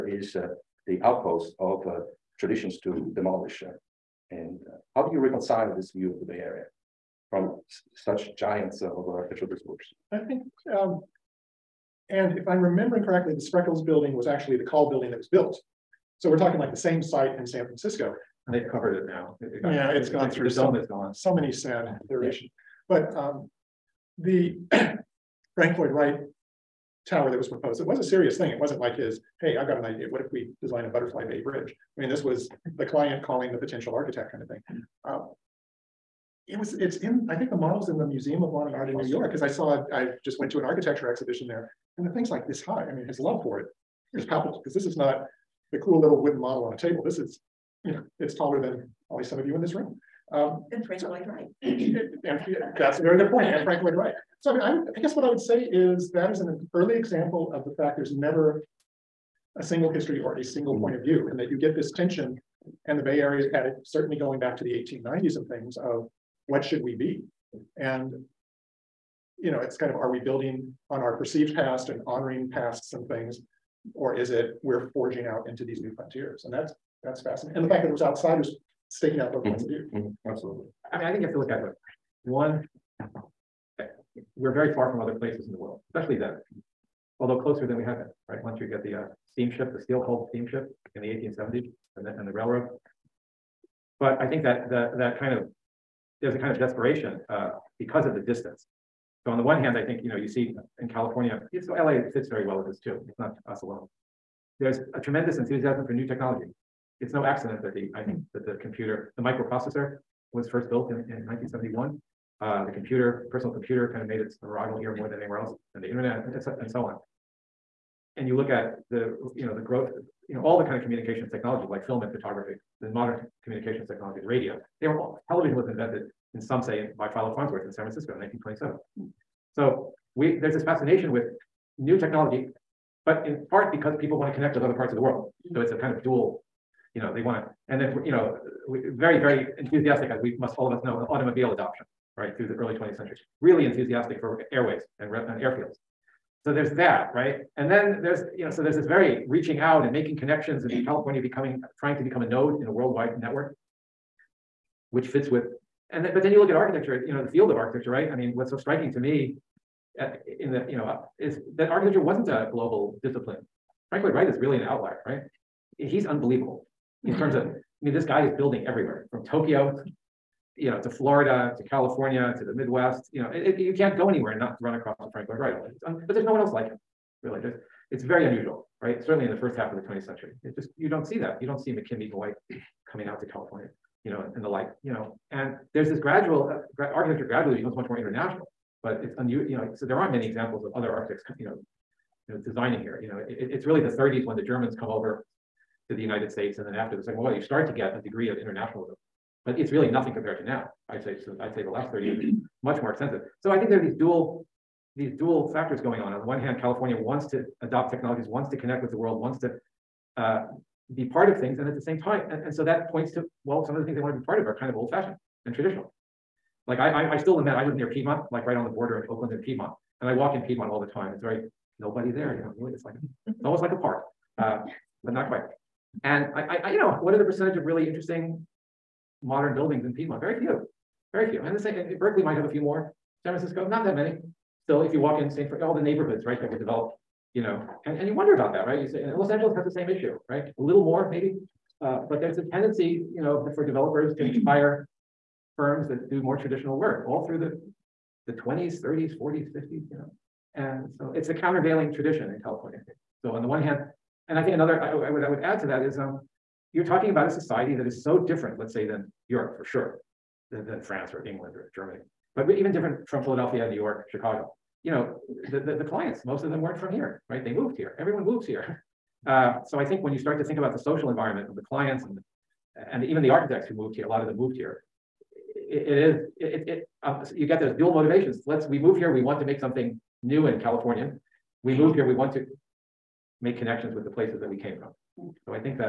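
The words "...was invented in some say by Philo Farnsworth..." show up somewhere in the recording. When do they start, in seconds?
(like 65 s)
125 s.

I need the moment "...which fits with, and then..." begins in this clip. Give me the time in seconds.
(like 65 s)
154 s.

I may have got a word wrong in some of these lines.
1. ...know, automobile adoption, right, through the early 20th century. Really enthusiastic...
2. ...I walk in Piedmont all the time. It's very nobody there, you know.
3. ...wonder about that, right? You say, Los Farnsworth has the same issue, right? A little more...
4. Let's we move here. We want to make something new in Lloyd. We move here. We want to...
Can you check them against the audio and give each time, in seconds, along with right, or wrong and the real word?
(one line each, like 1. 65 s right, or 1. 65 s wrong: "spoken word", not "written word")
1. 140 s right
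2. 220 s right
3. 238 s wrong: "Angeles", not "Farnsworth"
4. 278 s wrong: "California", not "Lloyd".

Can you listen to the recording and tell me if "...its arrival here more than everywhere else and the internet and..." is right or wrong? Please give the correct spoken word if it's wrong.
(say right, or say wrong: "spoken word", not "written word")
wrong: "anywhere", not "everywhere".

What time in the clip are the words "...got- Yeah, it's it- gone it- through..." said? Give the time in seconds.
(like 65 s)
19 s.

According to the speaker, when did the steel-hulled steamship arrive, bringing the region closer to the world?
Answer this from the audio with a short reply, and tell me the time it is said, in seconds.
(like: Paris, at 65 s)
1870s, at 91 s.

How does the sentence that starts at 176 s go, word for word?
but there's no one else like him, really.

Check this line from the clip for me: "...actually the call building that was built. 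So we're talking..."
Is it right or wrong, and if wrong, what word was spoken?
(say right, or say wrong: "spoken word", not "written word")
right.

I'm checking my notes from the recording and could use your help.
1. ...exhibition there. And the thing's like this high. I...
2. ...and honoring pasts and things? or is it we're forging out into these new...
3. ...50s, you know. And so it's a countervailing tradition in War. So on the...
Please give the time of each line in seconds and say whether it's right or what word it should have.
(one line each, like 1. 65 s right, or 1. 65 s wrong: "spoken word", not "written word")
1. 41 s right
2. 71 s right
3. 249 s wrong: "California", not "War".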